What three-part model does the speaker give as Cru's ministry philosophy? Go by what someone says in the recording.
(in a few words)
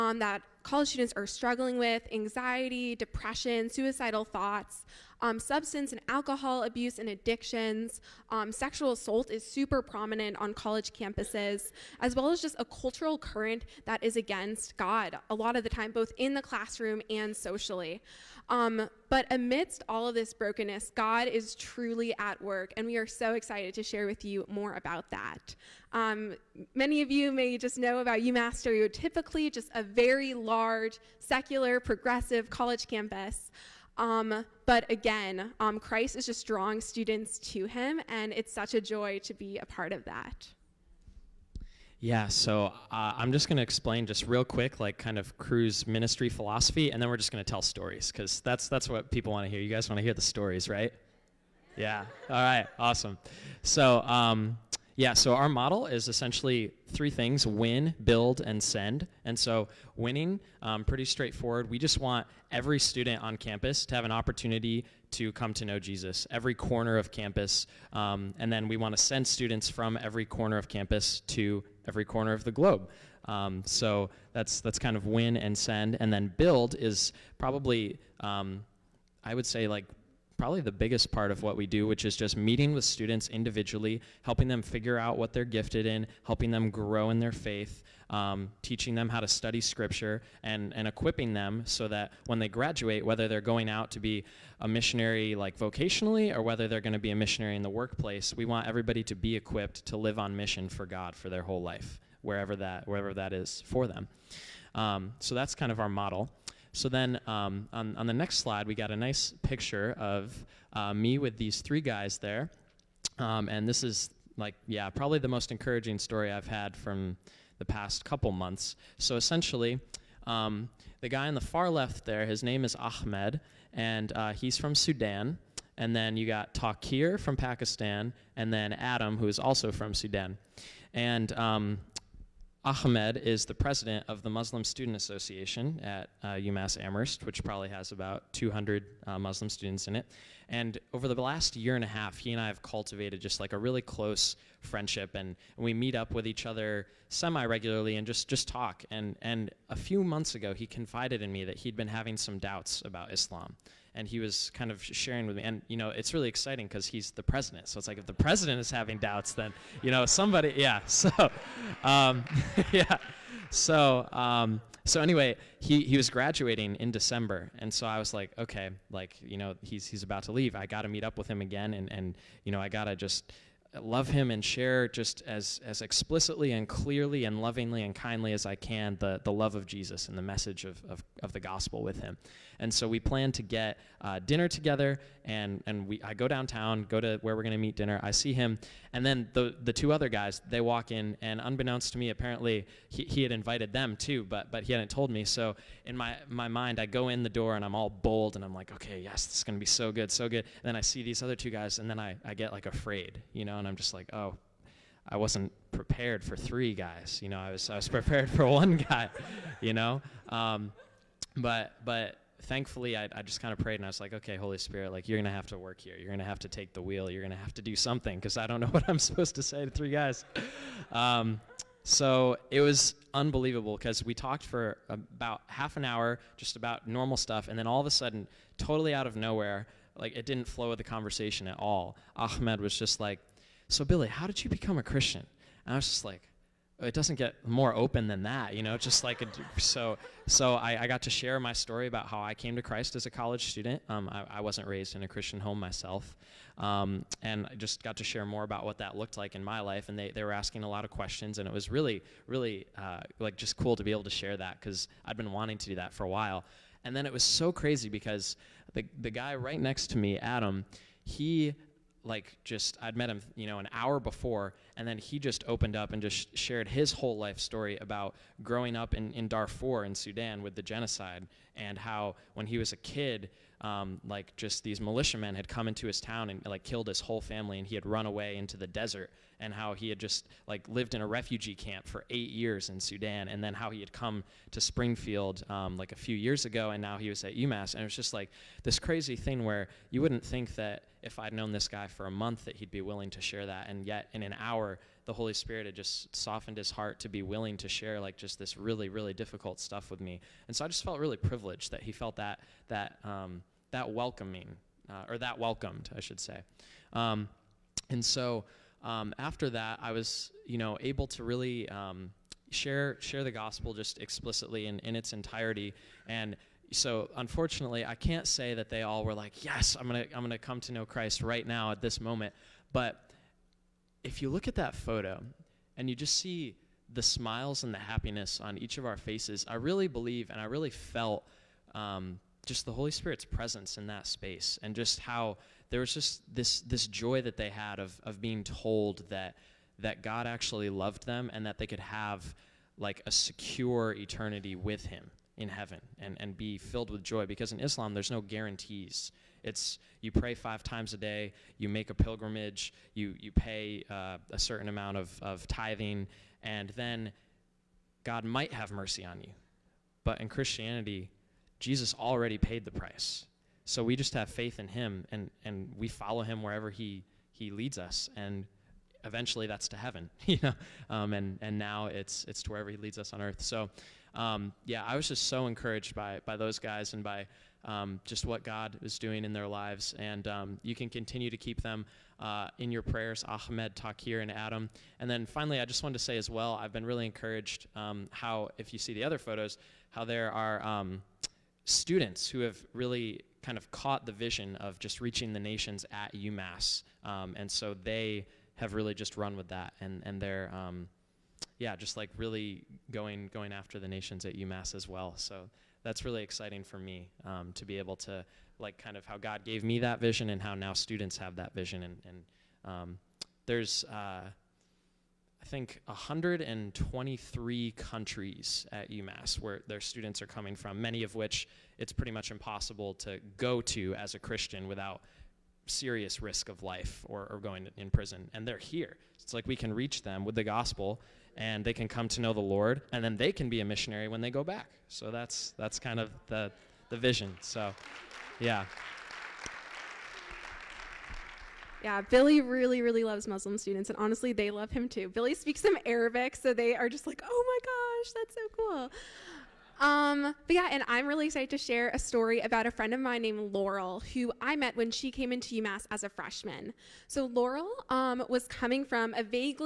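win, build, and send.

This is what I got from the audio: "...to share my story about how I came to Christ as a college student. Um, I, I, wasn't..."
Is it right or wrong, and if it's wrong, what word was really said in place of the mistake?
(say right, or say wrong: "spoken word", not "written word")
right.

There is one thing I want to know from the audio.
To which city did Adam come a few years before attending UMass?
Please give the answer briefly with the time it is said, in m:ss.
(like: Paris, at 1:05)
Springfield, at 4:44.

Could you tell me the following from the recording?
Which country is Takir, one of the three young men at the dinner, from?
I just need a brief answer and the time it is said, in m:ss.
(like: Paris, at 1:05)
Pakistan, at 2:07.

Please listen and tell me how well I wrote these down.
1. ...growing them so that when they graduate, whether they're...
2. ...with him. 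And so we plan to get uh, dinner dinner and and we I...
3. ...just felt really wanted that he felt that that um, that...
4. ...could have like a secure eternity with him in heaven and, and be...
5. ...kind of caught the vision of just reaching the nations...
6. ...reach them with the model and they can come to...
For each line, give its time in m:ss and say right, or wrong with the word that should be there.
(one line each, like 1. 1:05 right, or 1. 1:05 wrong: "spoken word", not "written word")
1. 1:30 wrong: "equipping", not "growing"
2. 3:01 wrong: "together", not "dinner"
3. 5:00 wrong: "privileged", not "wanted"
4. 5:41 right
5. 6:33 right
6. 7:09 wrong: "gospel", not "model".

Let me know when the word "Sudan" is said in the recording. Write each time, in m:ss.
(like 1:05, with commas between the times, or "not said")
2:04, 2:09, 4:29, 4:42.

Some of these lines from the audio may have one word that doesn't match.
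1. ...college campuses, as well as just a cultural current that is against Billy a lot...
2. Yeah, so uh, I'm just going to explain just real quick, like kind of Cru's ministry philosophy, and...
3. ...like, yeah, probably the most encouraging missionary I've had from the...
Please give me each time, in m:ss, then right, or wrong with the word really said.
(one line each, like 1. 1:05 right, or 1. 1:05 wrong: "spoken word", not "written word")
1. 0:10 wrong: "God", not "Billy"
2. 0:41 right
3. 1:54 wrong: "story", not "missionary".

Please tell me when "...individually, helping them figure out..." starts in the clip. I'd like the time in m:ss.
1:23.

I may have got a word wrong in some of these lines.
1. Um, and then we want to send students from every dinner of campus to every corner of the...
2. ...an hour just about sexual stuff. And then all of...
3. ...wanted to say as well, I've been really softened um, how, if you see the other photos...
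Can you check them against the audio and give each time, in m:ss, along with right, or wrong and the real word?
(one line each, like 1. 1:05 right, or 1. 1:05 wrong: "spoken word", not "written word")
1. 1:07 wrong: "corner", not "dinner"
2. 3:45 wrong: "normal", not "sexual"
3. 6:25 wrong: "encouraged", not "softened".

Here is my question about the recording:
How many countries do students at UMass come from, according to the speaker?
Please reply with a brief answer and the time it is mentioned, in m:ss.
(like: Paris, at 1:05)
123, at 6:55.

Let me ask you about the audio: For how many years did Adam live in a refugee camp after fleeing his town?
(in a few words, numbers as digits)
8.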